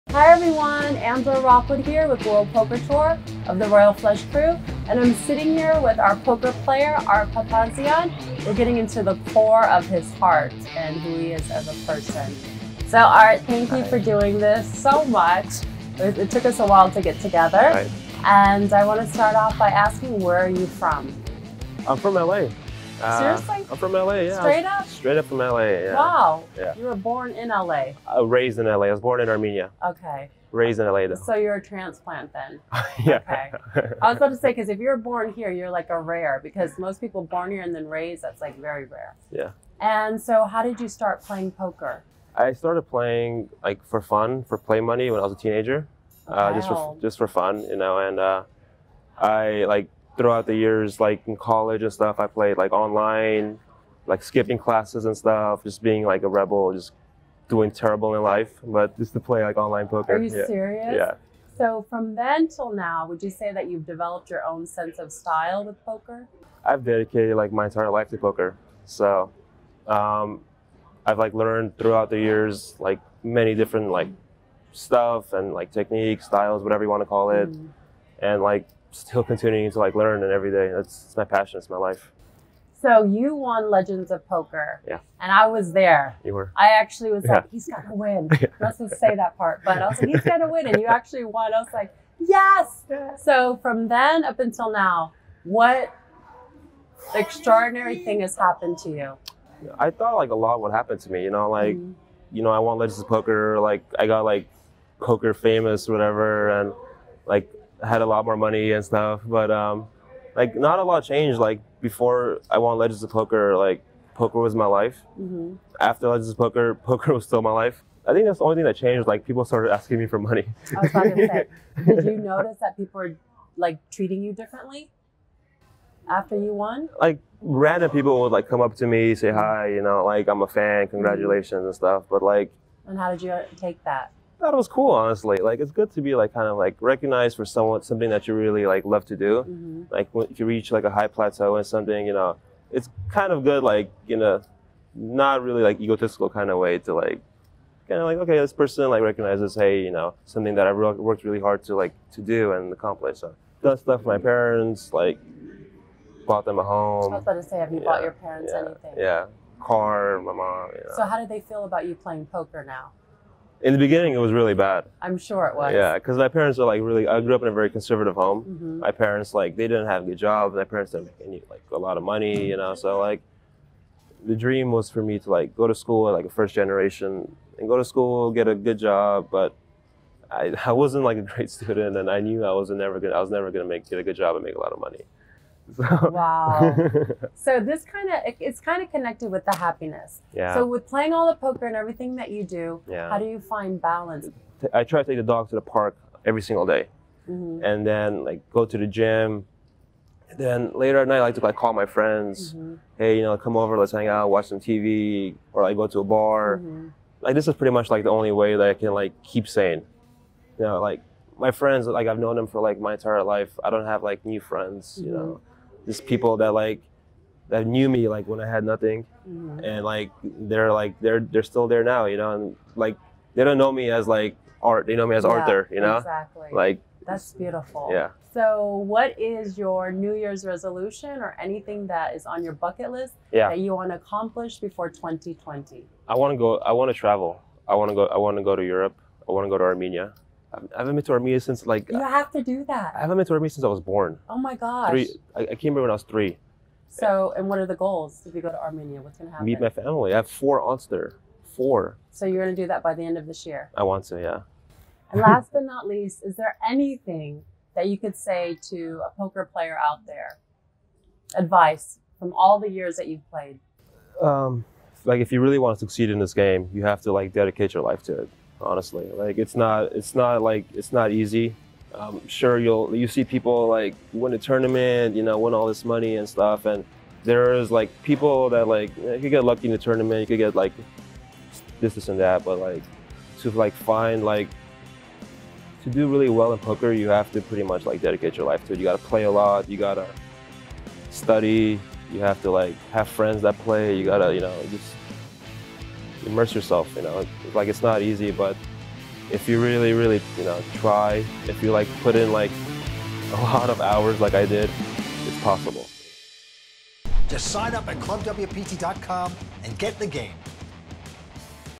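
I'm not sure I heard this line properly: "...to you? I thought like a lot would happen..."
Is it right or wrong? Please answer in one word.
right.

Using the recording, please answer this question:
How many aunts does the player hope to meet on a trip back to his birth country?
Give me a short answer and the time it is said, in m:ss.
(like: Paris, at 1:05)
4, at 4:10.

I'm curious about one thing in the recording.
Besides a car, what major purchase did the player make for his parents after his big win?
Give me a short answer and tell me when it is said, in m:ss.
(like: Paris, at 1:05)
A home, at 2:36.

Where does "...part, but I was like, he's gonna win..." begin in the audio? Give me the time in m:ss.
1:29.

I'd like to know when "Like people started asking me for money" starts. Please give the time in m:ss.
1:59.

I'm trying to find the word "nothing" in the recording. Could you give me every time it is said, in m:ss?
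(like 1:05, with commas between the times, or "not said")
3:38.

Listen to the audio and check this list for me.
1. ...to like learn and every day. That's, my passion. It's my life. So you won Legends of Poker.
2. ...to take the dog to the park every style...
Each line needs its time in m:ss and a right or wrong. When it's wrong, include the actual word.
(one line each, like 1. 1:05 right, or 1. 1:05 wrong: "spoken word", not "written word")
1. 1:19 right
2. 3:15 wrong: "single", not "style".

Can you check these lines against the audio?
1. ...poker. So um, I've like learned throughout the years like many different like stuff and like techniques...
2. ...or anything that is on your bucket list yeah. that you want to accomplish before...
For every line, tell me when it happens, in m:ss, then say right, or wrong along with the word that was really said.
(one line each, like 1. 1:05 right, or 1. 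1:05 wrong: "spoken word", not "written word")
1. 1:08 right
2. 3:51 right.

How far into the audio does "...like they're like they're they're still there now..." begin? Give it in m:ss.
3:39.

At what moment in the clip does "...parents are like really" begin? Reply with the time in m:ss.
2:46.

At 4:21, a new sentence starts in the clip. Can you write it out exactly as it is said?
Advice from all the years that you've played.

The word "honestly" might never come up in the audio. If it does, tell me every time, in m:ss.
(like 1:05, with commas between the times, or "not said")
2:14, 4:28.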